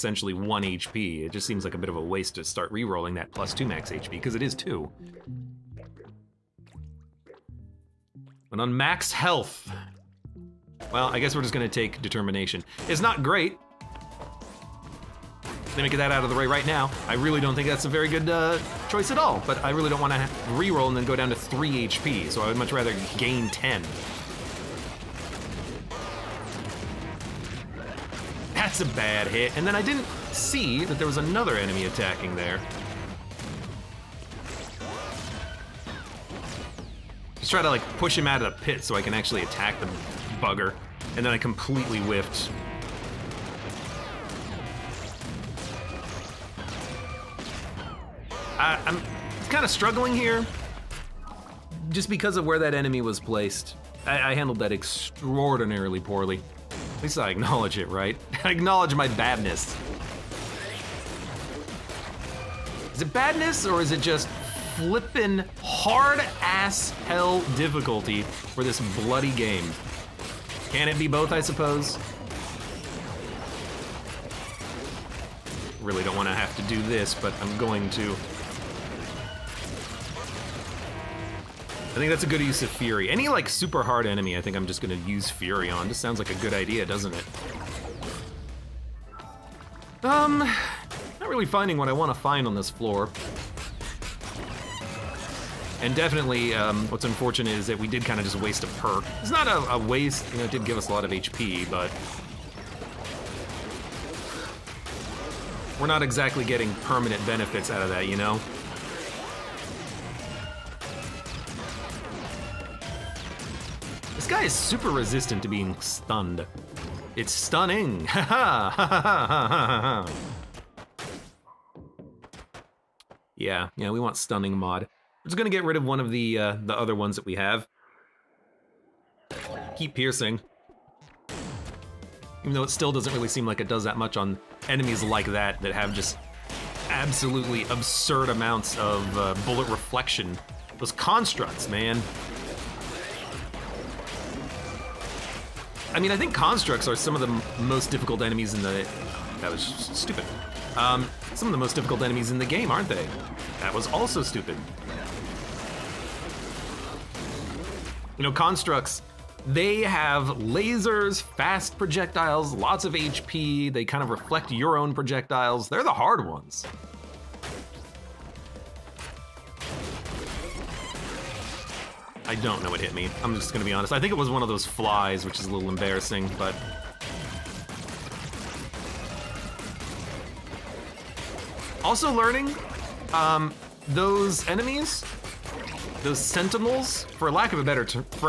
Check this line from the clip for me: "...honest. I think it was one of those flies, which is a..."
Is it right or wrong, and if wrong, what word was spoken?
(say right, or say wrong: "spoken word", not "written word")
right.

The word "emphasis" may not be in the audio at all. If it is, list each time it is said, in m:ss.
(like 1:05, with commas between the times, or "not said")
not said.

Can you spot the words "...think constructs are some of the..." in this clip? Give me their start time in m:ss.
2:26.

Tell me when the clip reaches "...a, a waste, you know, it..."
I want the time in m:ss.
1:39.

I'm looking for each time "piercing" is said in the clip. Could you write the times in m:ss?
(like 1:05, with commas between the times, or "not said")
2:09.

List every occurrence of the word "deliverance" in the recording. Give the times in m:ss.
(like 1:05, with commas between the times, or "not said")
not said.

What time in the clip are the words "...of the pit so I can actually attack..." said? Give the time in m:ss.
0:38.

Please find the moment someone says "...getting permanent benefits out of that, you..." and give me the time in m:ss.
1:46.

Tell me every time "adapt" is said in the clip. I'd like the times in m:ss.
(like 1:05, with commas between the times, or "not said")
not said.